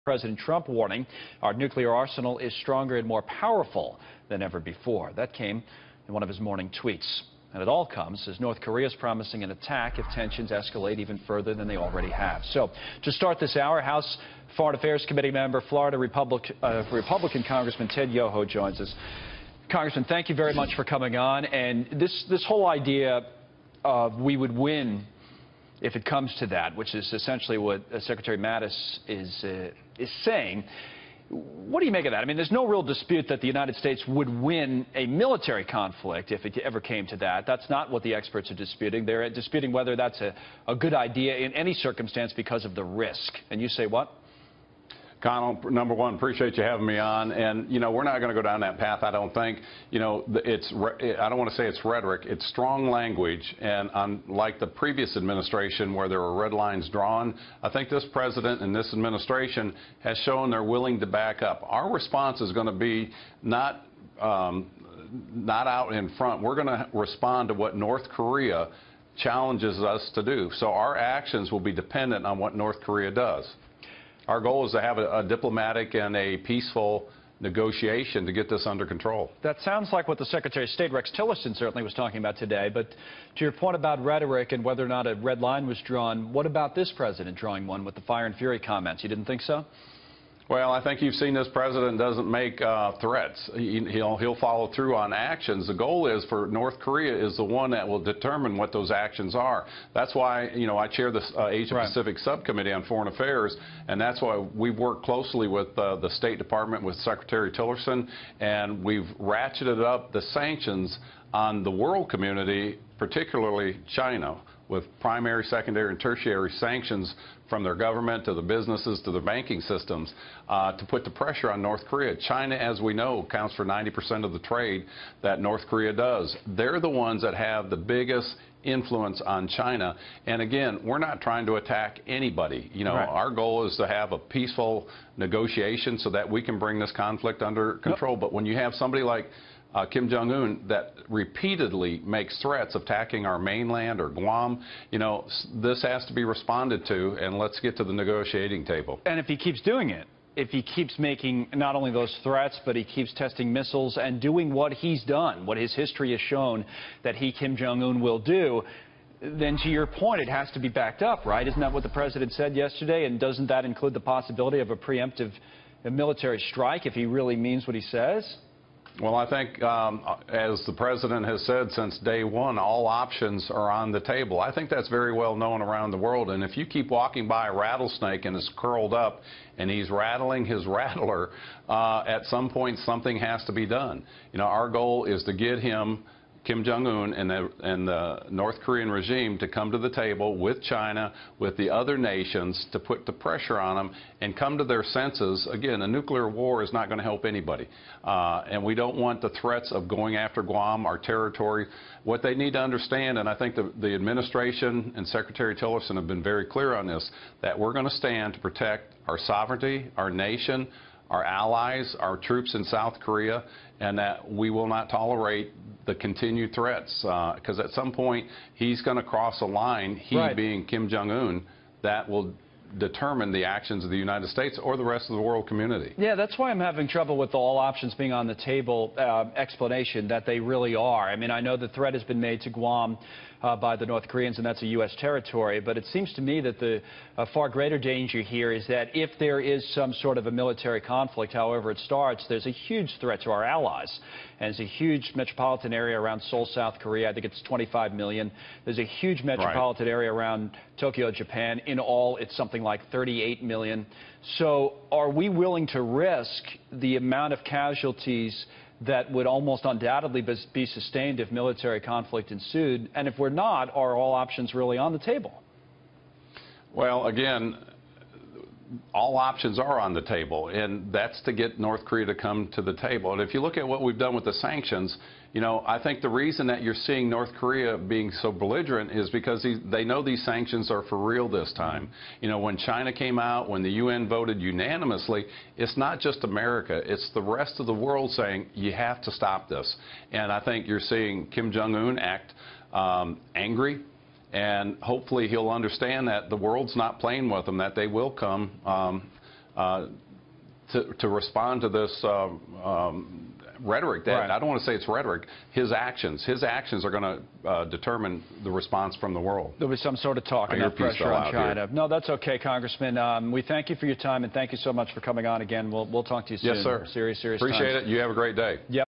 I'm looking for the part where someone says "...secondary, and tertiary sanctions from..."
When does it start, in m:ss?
1:55.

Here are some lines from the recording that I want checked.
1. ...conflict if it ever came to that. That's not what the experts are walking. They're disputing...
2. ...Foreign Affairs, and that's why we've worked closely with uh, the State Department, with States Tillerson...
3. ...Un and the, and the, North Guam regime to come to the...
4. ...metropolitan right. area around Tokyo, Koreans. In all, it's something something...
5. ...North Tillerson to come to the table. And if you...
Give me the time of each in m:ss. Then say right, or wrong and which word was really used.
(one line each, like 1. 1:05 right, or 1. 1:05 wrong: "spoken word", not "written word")
1. 0:35 wrong: "disputing", not "walking"
2. 1:42 wrong: "Secretary", not "States"
3. 3:06 wrong: "Korean", not "Guam"
4. 4:09 wrong: "Japan", not "Koreans"
5. 4:31 wrong: "Korea", not "Tillerson".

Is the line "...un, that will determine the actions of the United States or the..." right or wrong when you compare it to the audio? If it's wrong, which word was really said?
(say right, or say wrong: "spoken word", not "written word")
right.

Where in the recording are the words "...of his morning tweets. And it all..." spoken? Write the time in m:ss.
0:06.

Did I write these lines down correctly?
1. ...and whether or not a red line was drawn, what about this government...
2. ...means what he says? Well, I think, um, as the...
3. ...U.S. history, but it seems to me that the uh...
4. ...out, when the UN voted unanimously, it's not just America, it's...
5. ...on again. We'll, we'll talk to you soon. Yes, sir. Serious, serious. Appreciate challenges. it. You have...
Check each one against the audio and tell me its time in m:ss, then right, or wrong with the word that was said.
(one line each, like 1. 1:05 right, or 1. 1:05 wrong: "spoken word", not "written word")
1. 1:24 wrong: "president", not "government"
2. 2:47 right
3. 3:54 wrong: "territory", not "history"
4. 4:43 right
5. 5:15 wrong: "times", not "challenges".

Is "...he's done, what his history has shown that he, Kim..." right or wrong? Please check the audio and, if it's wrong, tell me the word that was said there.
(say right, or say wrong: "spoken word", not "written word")
right.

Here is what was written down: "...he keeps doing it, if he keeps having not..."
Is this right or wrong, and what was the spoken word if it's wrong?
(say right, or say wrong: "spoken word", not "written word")
wrong: "making", not "having".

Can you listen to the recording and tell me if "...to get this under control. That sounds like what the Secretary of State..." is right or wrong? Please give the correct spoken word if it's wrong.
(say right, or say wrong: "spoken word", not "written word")
right.